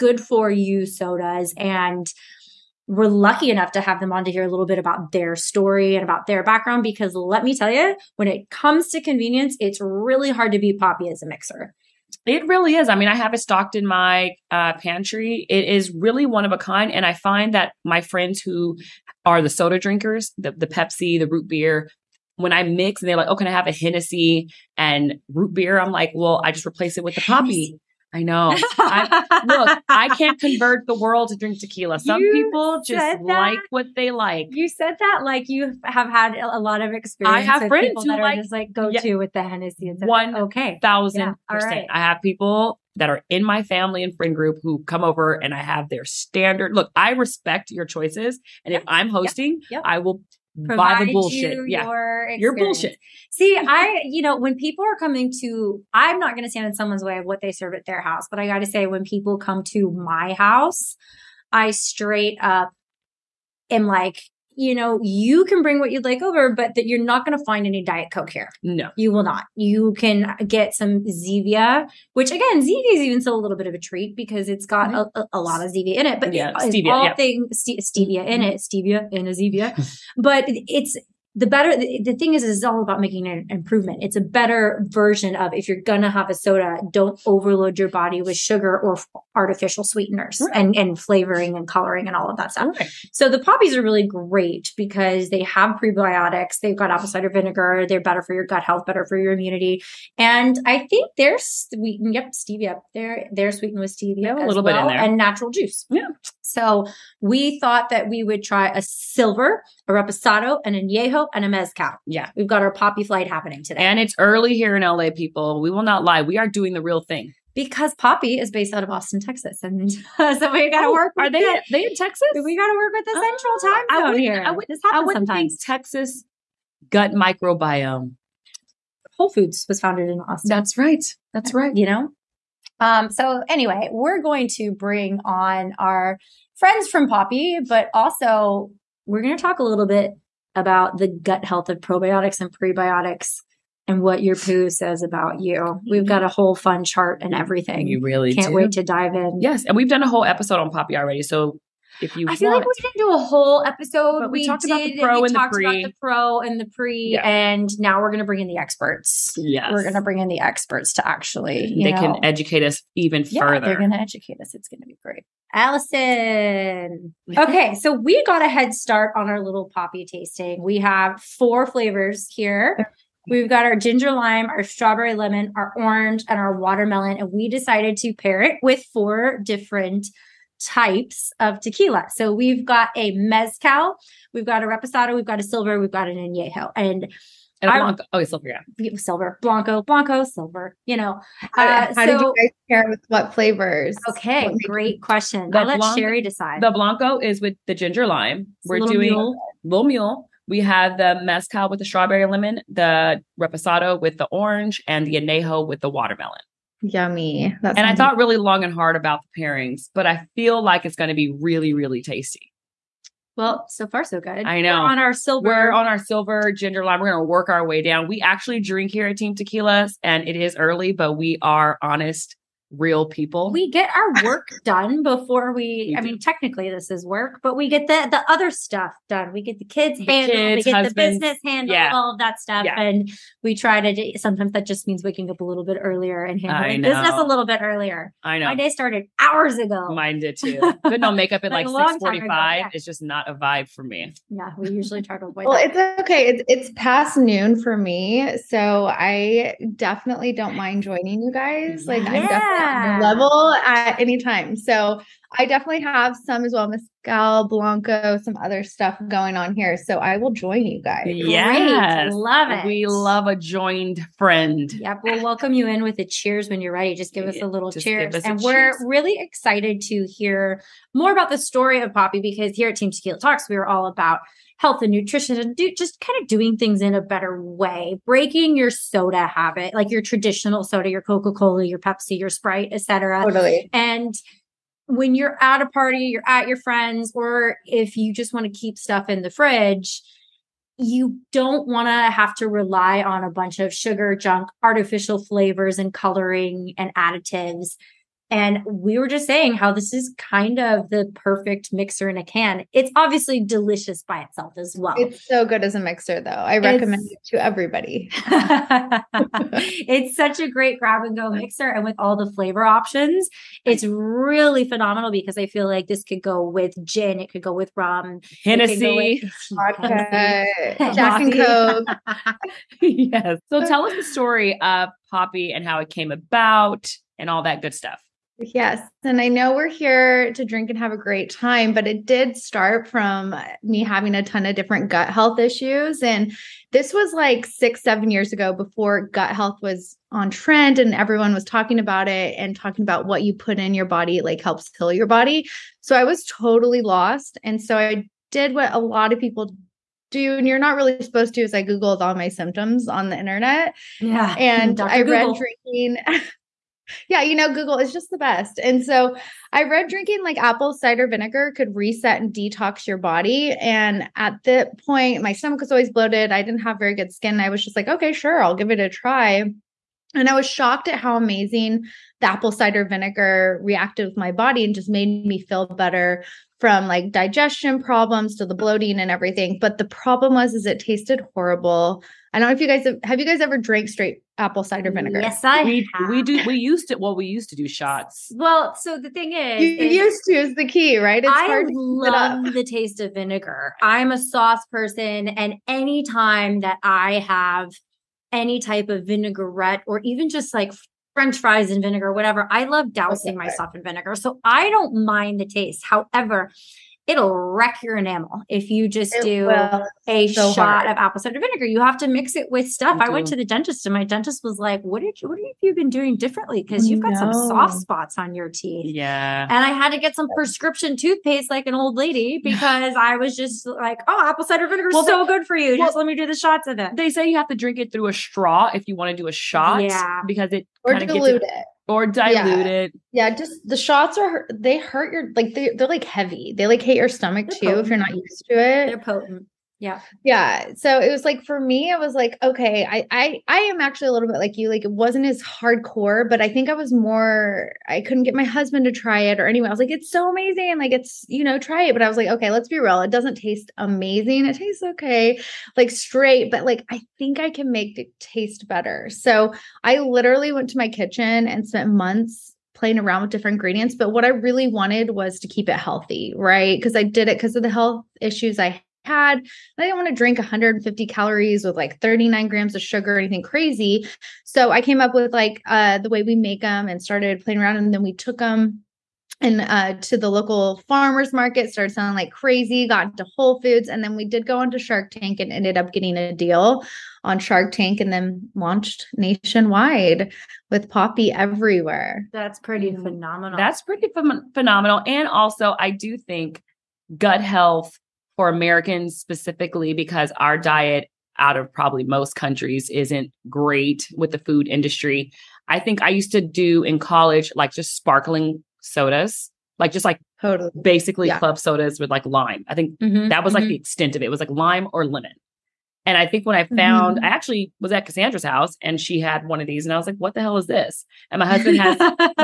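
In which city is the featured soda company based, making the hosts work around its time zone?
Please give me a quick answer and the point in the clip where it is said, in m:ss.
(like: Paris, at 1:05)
Austin, Texas, at 1:58.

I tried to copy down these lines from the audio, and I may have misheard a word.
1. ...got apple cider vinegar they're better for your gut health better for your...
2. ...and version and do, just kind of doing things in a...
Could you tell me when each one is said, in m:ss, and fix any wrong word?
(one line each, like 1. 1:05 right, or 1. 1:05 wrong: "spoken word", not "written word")
1. 1:36 right
2. 4:34 wrong: "nutrition", not "version".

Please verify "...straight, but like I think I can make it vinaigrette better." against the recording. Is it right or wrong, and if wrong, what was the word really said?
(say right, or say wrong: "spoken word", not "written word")
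wrong: "taste", not "vinaigrette".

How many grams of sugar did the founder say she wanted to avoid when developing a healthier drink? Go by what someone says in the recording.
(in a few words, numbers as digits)
39.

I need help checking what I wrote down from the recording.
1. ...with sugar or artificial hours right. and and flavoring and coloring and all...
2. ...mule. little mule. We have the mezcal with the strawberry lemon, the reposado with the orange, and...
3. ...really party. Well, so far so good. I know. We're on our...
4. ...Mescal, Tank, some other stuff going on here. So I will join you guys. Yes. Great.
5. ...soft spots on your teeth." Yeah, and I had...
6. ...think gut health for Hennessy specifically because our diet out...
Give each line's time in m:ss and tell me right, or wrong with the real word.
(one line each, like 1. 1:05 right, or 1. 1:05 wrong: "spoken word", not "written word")
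1. 1:28 wrong: "sweeteners", not "hours"
2. 3:19 right
3. 3:31 wrong: "tasty", not "party"
4. 4:16 wrong: "Blanco", not "Tank"
5. 6:57 right
6. 8:16 wrong: "Americans", not "Hennessy".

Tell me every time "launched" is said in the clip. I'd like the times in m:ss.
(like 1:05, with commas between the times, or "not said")
8:08.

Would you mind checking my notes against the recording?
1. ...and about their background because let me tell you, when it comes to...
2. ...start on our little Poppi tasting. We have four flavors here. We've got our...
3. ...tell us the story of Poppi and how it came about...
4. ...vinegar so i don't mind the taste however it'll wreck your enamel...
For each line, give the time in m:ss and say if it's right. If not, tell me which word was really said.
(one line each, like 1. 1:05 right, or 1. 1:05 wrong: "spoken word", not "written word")
1. 0:05 right
2. 2:48 right
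3. 5:23 right
4. 6:43 right.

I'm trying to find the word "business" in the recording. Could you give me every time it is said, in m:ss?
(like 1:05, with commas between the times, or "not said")
3:51, 3:56.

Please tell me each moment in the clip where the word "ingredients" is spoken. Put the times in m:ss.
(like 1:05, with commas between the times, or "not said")
7:43.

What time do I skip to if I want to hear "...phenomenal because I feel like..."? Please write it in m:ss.
5:14.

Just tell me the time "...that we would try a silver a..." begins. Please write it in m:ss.
1:47.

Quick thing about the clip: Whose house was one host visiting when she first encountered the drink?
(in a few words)
Cassandra's.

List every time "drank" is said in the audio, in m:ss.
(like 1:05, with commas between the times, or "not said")
6:23.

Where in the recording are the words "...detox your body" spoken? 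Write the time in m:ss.
6:02.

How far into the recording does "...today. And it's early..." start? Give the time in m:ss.
1:53.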